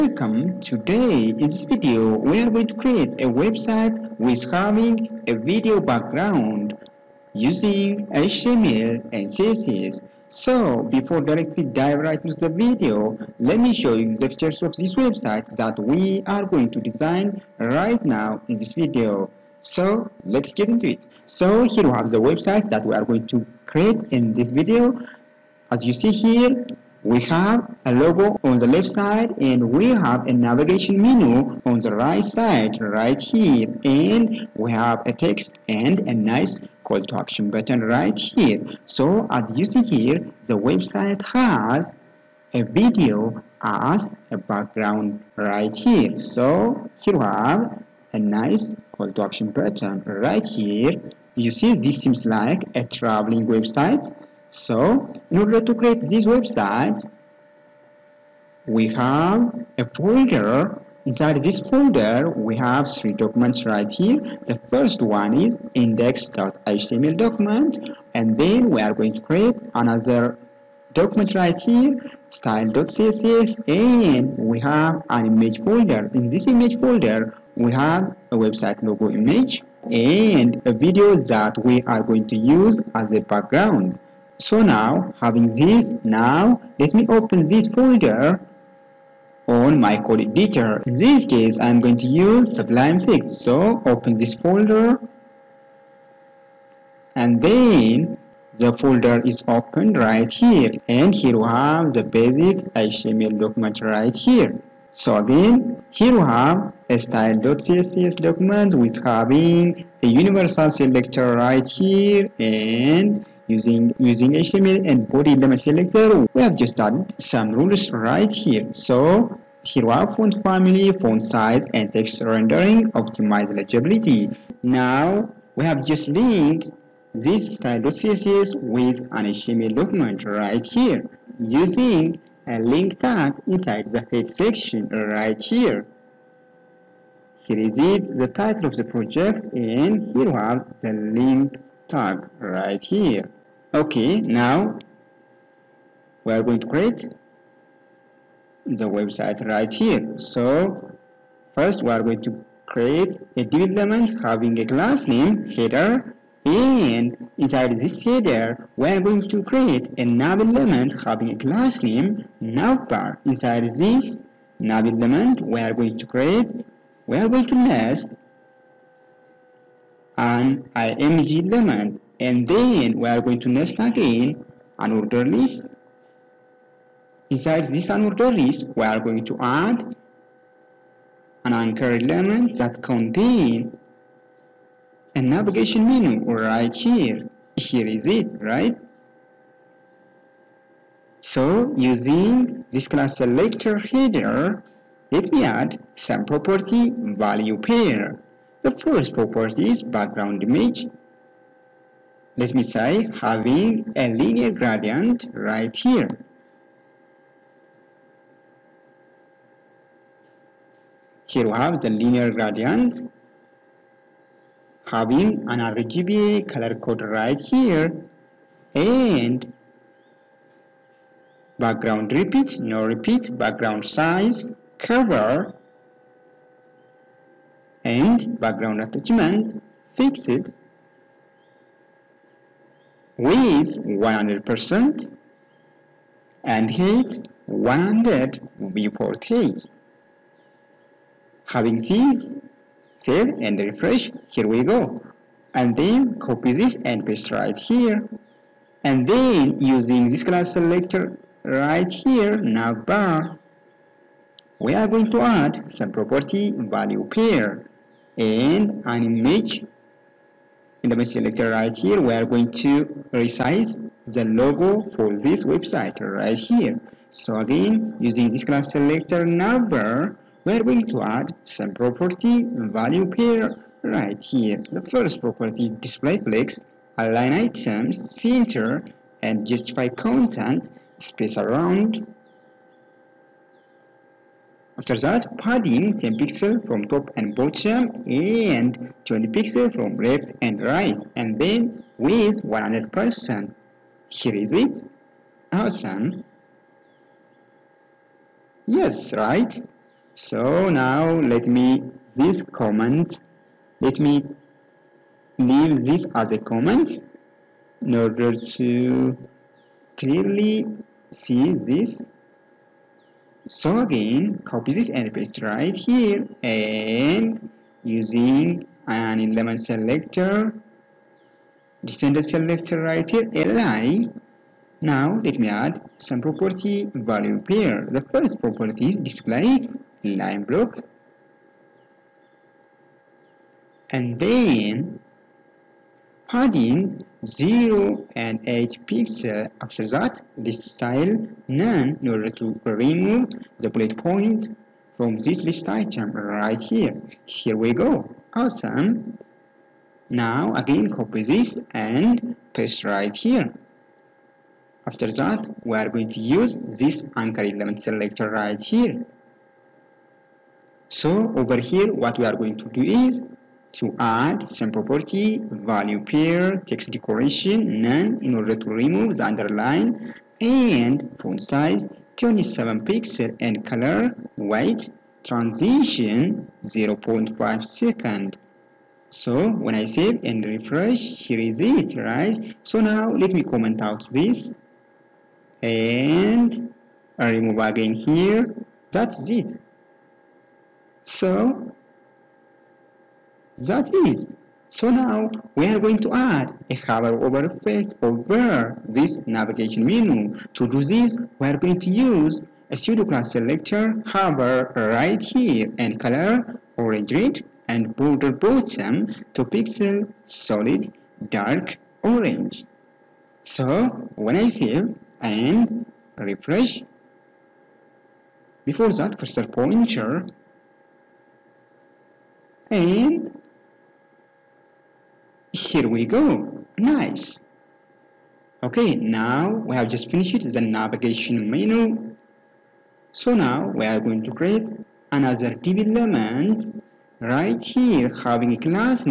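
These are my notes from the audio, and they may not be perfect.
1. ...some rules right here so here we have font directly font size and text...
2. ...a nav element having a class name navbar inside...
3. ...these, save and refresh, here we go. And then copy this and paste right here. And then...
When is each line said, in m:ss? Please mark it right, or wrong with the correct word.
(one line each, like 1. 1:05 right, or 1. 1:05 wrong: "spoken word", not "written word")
1. 1:57 wrong: "family", not "directly"
2. 2:39 right
3. 4:01 right.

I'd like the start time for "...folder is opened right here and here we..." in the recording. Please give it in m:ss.
1:38.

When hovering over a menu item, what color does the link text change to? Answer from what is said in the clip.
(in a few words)
orange red.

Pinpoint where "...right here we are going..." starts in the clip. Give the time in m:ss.
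4:21.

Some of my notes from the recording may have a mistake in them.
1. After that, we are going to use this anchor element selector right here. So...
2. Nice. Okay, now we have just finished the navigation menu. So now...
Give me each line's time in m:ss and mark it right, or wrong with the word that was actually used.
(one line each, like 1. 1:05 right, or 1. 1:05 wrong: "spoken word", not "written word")
1. 5:54 right
2. 7:06 right.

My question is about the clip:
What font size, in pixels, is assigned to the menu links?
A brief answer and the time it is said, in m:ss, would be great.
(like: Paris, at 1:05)
27 pixels, at 6:12.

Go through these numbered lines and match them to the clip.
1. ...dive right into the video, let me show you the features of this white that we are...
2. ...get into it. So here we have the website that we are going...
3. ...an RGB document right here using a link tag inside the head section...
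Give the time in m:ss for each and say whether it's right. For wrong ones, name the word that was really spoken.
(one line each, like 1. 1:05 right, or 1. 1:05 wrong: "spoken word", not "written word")
1. 0:11 wrong: "website", not "white"
2. 0:20 right
3. 2:09 wrong: "HTML", not "RGB".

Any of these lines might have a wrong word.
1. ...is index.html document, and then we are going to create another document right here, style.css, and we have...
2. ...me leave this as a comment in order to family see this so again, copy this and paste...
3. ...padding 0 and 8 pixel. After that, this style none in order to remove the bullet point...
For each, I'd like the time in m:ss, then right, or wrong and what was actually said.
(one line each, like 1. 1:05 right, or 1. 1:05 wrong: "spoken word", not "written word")
1. 1:05 right
2. 5:03 wrong: "clearly", not "family"
3. 5:36 right.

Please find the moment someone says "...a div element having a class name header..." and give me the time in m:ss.
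2:33.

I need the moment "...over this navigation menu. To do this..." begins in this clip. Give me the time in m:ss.
6:38.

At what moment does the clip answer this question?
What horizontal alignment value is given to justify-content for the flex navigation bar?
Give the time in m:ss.
4:40.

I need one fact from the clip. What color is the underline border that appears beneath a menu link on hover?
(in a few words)
dark orange.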